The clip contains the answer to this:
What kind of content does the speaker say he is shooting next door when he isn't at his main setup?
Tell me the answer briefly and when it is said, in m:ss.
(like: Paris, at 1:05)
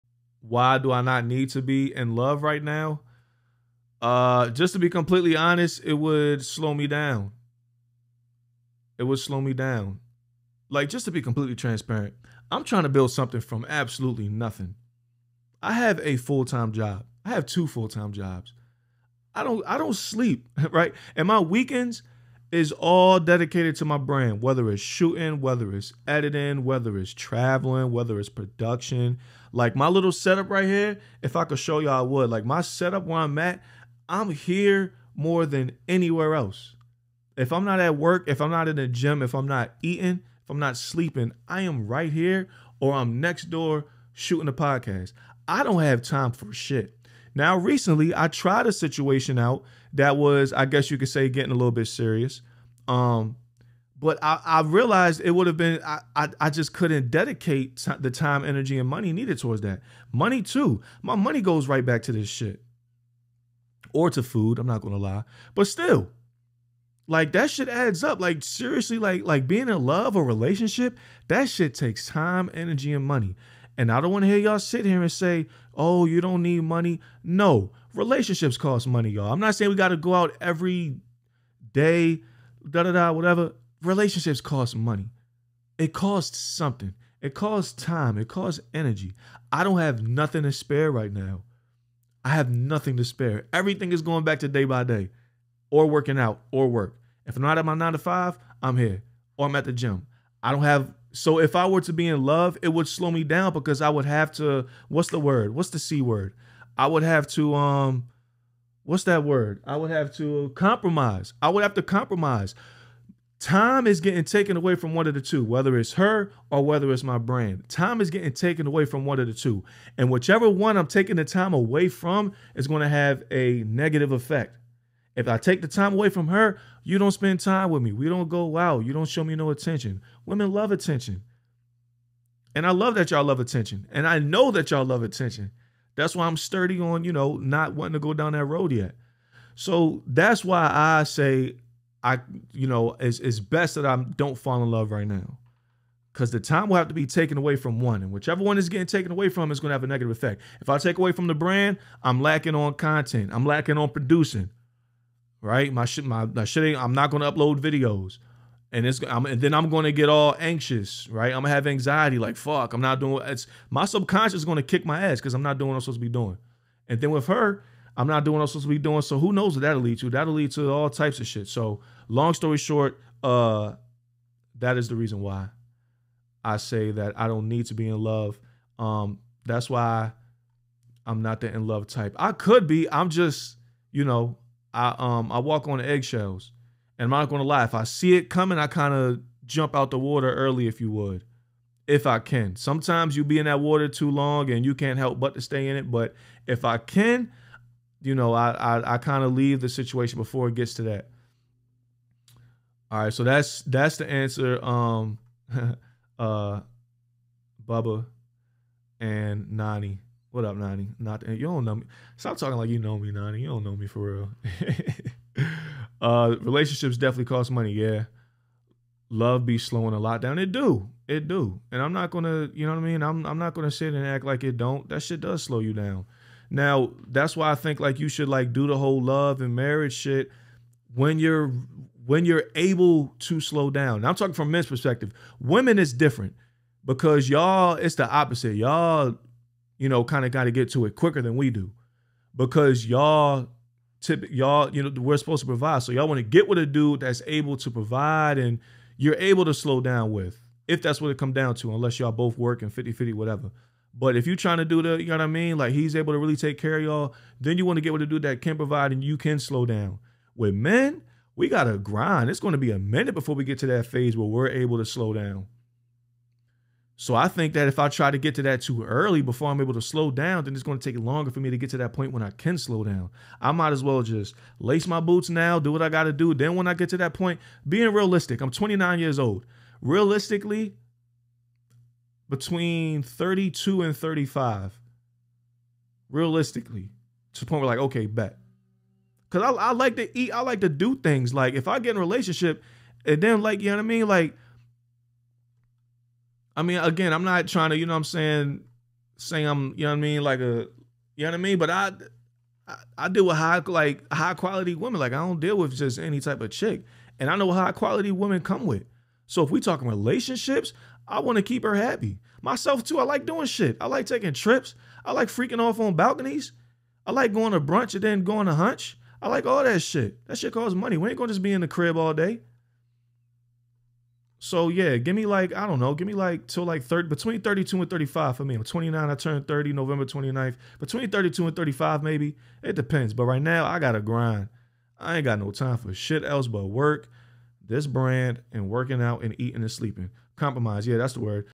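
A podcast, at 0:44.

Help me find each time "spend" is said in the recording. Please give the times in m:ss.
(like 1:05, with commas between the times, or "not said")
2:07.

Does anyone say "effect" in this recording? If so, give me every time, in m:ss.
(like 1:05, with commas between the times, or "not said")
2:04, 2:30.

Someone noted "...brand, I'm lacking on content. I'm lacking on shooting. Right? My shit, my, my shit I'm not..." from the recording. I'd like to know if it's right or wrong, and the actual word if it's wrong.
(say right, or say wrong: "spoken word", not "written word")
wrong: "producing", not "shooting".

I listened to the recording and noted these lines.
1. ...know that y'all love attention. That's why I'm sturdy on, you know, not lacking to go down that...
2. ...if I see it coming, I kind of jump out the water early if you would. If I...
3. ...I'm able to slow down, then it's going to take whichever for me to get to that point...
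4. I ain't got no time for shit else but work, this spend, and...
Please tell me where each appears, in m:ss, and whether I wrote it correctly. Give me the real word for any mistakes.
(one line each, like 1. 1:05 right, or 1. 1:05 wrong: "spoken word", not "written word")
1. 2:14 wrong: "wanting", not "lacking"
2. 3:07 right
3. 4:29 wrong: "longer", not "whichever"
4. 5:34 wrong: "brand", not "spend".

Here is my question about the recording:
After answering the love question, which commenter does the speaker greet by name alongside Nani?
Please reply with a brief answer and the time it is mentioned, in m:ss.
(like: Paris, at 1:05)
Bubba, at 3:27.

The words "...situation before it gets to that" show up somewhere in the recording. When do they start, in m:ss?
3:19.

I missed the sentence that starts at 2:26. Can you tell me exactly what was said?
Because the time will have to be taken away from one.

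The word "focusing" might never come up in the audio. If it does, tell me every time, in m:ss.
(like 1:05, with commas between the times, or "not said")
not said.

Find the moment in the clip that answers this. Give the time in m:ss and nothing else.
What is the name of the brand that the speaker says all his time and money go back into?
1:34.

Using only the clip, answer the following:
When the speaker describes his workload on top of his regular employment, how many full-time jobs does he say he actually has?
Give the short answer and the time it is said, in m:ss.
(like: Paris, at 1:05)
2, at 0:17.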